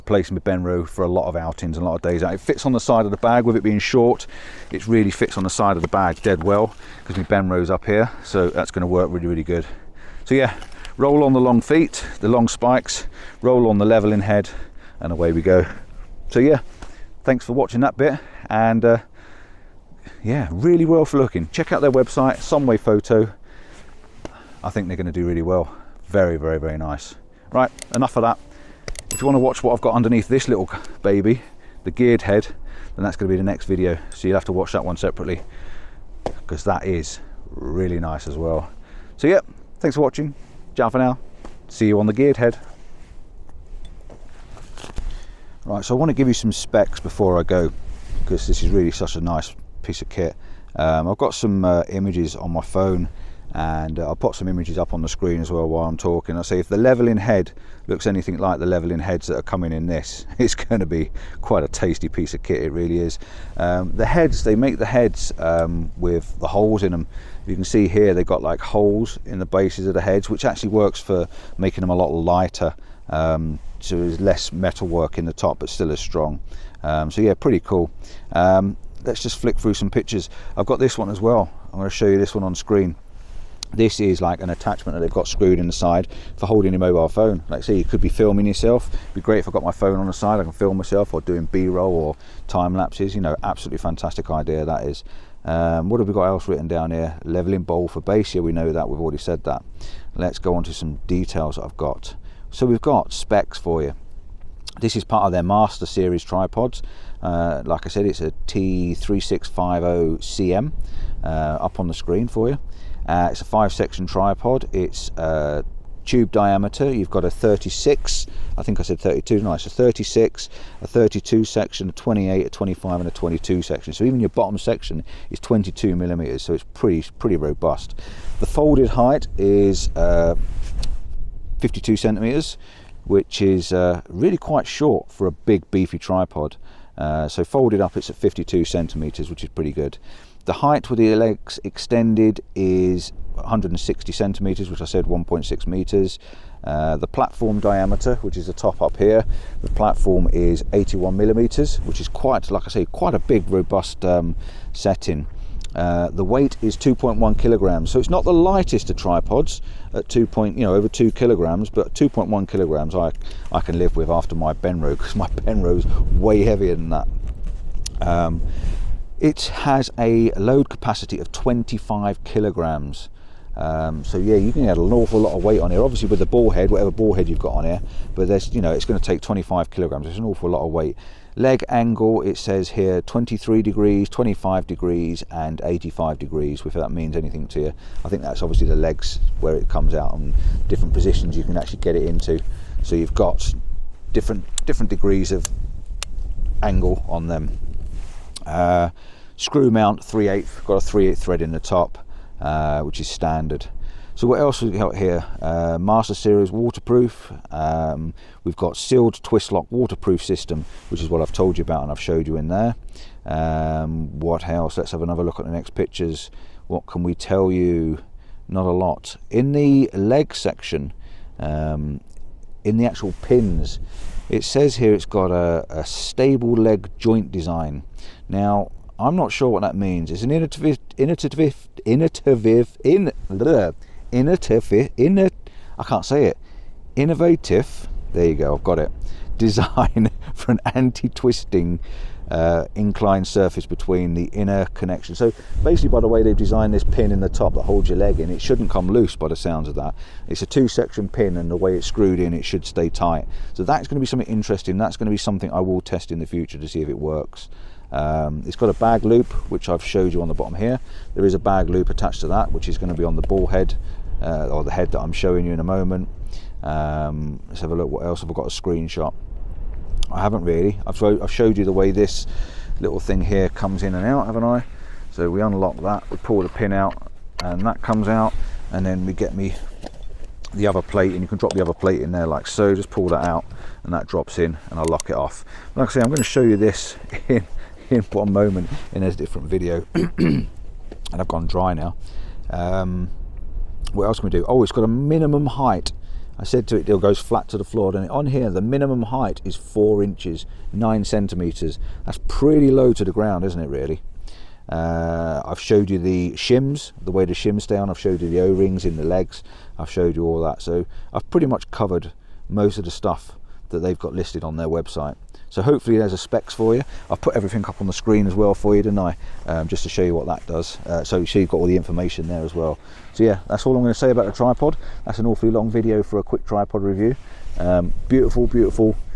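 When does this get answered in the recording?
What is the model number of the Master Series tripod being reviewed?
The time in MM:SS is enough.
01:48.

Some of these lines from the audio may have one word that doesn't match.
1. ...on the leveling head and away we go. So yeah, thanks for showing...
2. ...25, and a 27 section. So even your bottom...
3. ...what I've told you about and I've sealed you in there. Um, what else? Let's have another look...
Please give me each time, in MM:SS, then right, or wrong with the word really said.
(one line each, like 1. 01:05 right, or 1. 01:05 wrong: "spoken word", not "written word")
1. 00:13 wrong: "watching", not "showing"
2. 02:02 wrong: "22", not "27"
3. 03:31 wrong: "showed", not "sealed".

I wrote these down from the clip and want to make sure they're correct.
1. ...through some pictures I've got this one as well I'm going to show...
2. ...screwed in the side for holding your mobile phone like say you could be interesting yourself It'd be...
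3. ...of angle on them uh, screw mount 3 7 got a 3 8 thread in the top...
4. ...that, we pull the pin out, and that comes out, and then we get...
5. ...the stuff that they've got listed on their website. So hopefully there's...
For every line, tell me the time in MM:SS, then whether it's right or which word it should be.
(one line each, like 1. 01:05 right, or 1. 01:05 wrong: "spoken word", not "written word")
1. 01:19 right
2. 01:25 wrong: "filming", not "interesting"
3. 03:15 wrong: "8", not "7"
4. 04:35 right
5. 05:12 right.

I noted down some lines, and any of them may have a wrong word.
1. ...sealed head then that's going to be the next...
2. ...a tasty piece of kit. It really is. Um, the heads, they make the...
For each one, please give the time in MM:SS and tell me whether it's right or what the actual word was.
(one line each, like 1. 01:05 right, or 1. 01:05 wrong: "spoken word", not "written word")
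1. 00:31 wrong: "geared", not "sealed"
2. 01:01 right.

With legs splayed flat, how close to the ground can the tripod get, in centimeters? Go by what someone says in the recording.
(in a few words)
9 centimeters.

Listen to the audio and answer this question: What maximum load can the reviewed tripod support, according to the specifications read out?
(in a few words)
25 kilograms.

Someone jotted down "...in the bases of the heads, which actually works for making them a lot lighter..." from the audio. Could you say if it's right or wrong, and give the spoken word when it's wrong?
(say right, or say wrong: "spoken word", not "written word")
right.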